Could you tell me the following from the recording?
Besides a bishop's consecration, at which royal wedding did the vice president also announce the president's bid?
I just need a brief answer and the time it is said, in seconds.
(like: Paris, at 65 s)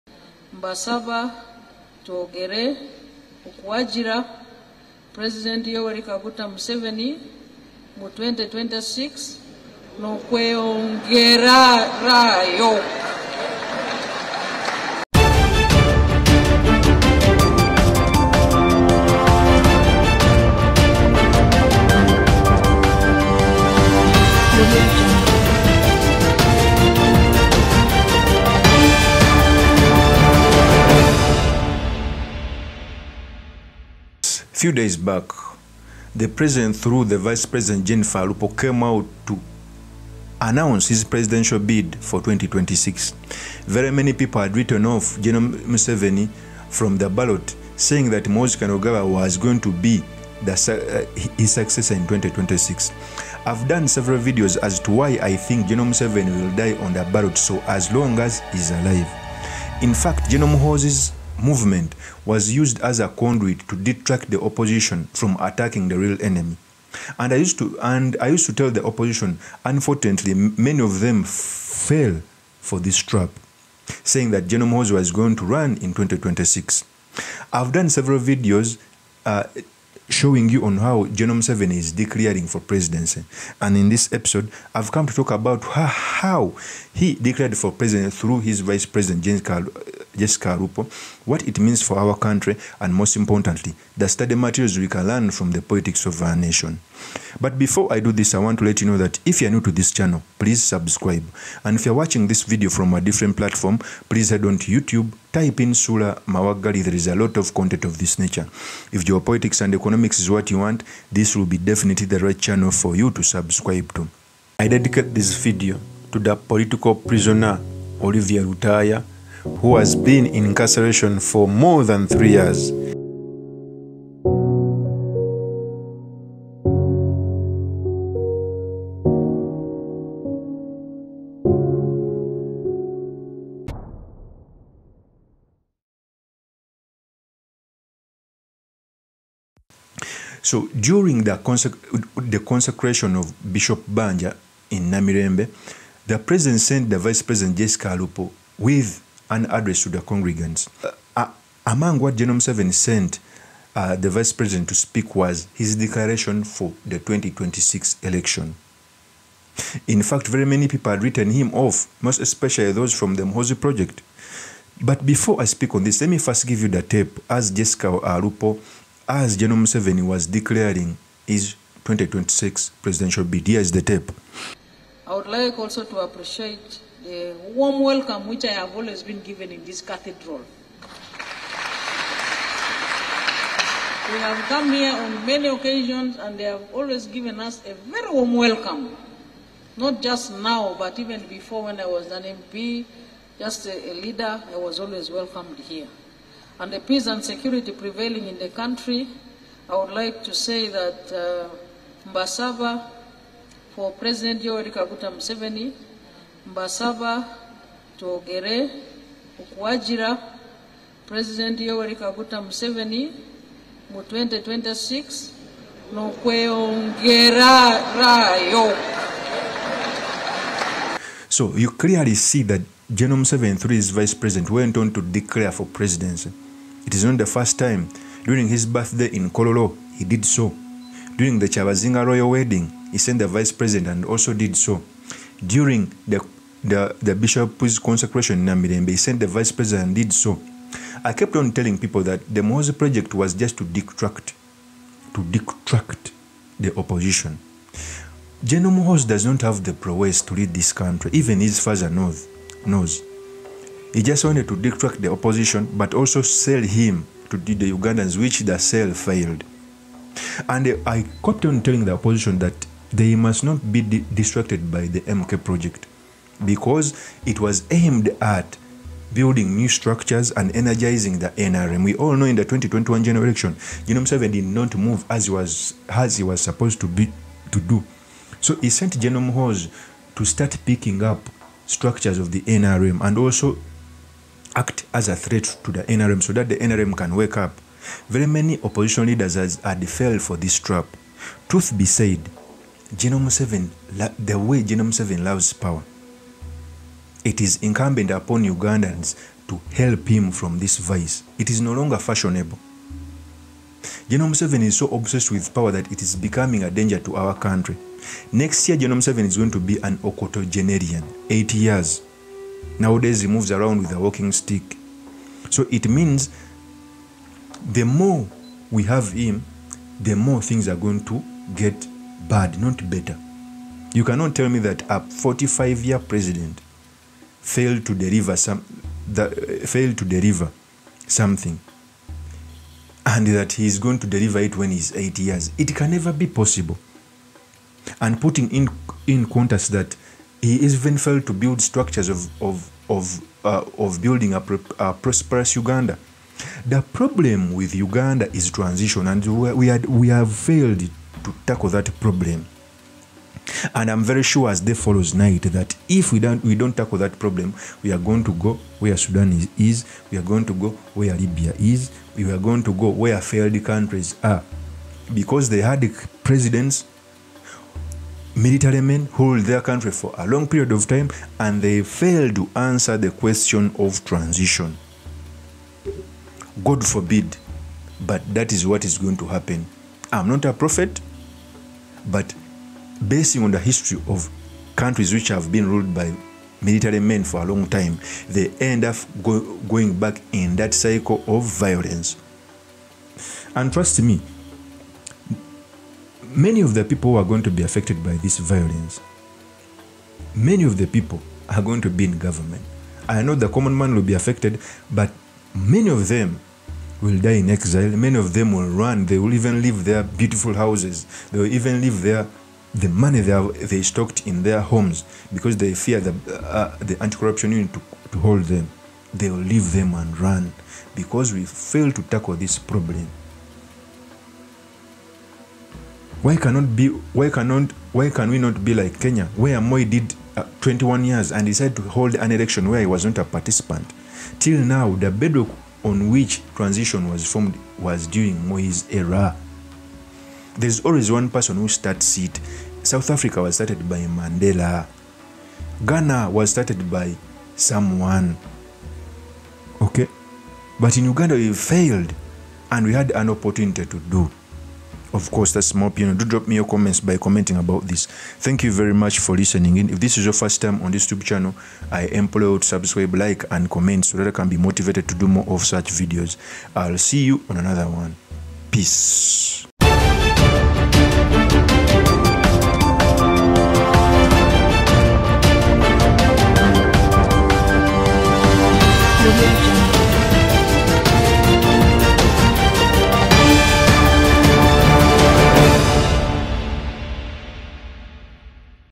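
Chabazinga royal wedding, at 231 s.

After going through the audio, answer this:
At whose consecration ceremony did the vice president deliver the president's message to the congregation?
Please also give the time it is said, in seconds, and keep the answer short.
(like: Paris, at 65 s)
Bishop Banja, at 143 s.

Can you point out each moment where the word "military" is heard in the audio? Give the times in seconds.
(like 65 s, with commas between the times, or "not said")
368 s, 386 s.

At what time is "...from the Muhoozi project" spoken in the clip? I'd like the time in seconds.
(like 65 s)
162 s.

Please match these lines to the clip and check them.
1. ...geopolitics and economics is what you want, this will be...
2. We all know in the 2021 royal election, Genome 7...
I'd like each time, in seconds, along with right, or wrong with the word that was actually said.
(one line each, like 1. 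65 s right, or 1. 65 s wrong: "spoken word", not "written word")
1. 109 s right
2. 271 s wrong: "general", not "royal".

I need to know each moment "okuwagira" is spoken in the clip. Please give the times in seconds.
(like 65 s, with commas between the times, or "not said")
3 s, 209 s.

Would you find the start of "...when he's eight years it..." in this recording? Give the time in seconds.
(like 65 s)
334 s.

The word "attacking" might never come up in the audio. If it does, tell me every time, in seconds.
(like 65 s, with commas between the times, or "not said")
65 s.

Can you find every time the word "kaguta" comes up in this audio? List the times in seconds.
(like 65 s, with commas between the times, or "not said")
6 s, 204 s, 211 s.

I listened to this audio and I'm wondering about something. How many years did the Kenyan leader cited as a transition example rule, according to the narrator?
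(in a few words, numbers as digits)
21.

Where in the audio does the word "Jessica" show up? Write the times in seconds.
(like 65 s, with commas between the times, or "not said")
90 s, 147 s, 167 s.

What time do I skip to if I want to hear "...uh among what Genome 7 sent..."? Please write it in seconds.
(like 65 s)
151 s.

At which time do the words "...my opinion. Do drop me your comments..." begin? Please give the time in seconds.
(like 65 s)
455 s.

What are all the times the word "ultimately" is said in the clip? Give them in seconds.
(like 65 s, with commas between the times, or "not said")
not said.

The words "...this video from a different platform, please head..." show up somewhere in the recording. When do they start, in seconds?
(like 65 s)
102 s.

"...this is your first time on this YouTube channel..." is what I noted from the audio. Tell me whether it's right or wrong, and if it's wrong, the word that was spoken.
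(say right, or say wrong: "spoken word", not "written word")
right.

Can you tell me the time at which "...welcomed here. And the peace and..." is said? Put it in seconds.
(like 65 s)
195 s.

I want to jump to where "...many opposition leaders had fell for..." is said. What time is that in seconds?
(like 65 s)
288 s.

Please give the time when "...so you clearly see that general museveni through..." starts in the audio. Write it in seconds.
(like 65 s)
221 s.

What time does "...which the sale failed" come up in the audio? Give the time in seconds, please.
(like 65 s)
258 s.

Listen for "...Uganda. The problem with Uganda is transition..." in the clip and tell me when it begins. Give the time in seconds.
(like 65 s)
345 s.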